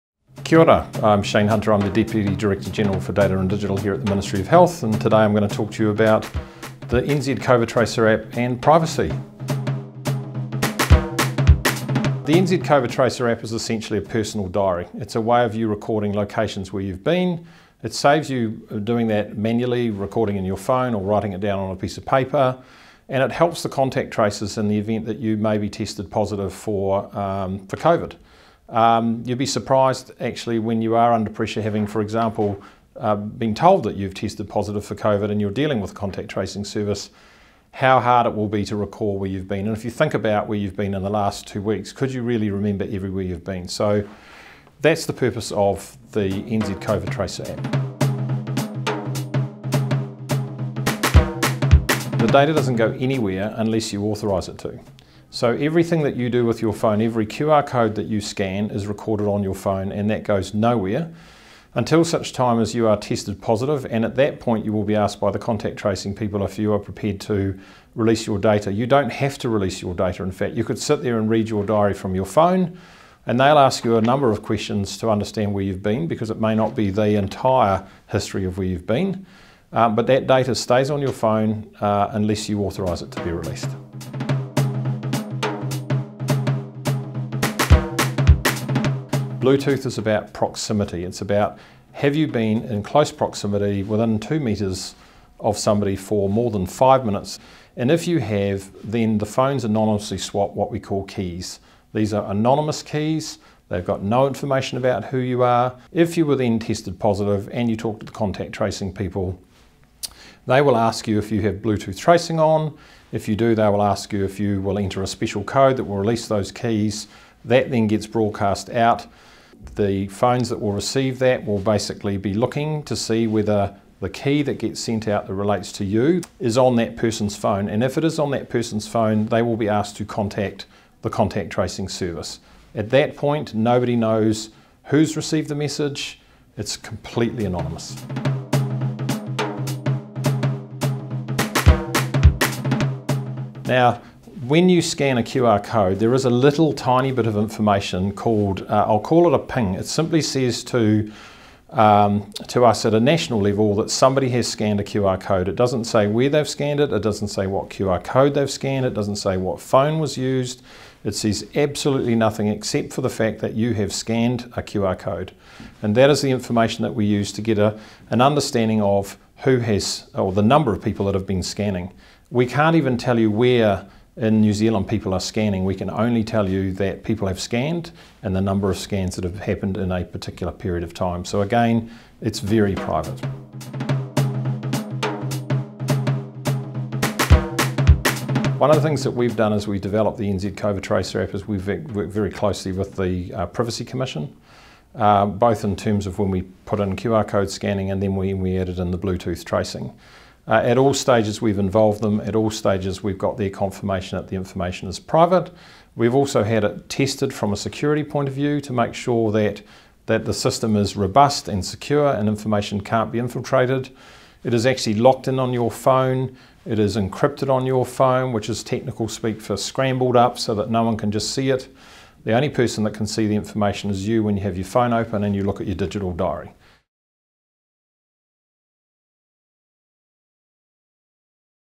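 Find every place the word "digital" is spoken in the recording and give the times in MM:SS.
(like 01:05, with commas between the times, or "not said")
00:03, 03:45.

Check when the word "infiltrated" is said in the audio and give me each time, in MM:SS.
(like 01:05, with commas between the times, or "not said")
03:33.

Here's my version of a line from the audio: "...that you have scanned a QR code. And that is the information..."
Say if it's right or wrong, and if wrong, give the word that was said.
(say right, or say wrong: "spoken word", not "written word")
right.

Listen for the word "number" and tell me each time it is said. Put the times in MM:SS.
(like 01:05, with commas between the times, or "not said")
01:14, 02:50, 02:58.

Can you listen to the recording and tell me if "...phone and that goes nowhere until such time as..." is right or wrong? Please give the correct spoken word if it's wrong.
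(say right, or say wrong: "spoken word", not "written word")
right.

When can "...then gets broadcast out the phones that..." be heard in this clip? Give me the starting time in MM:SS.
01:57.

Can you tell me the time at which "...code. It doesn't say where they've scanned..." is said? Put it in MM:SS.
02:35.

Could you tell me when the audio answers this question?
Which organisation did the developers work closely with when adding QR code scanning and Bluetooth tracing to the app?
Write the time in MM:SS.
03:13.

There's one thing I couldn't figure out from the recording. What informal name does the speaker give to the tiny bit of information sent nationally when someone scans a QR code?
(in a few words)
ping.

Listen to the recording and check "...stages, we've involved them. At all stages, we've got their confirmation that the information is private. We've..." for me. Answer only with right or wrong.
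right.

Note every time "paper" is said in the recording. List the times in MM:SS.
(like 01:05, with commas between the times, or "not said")
00:22.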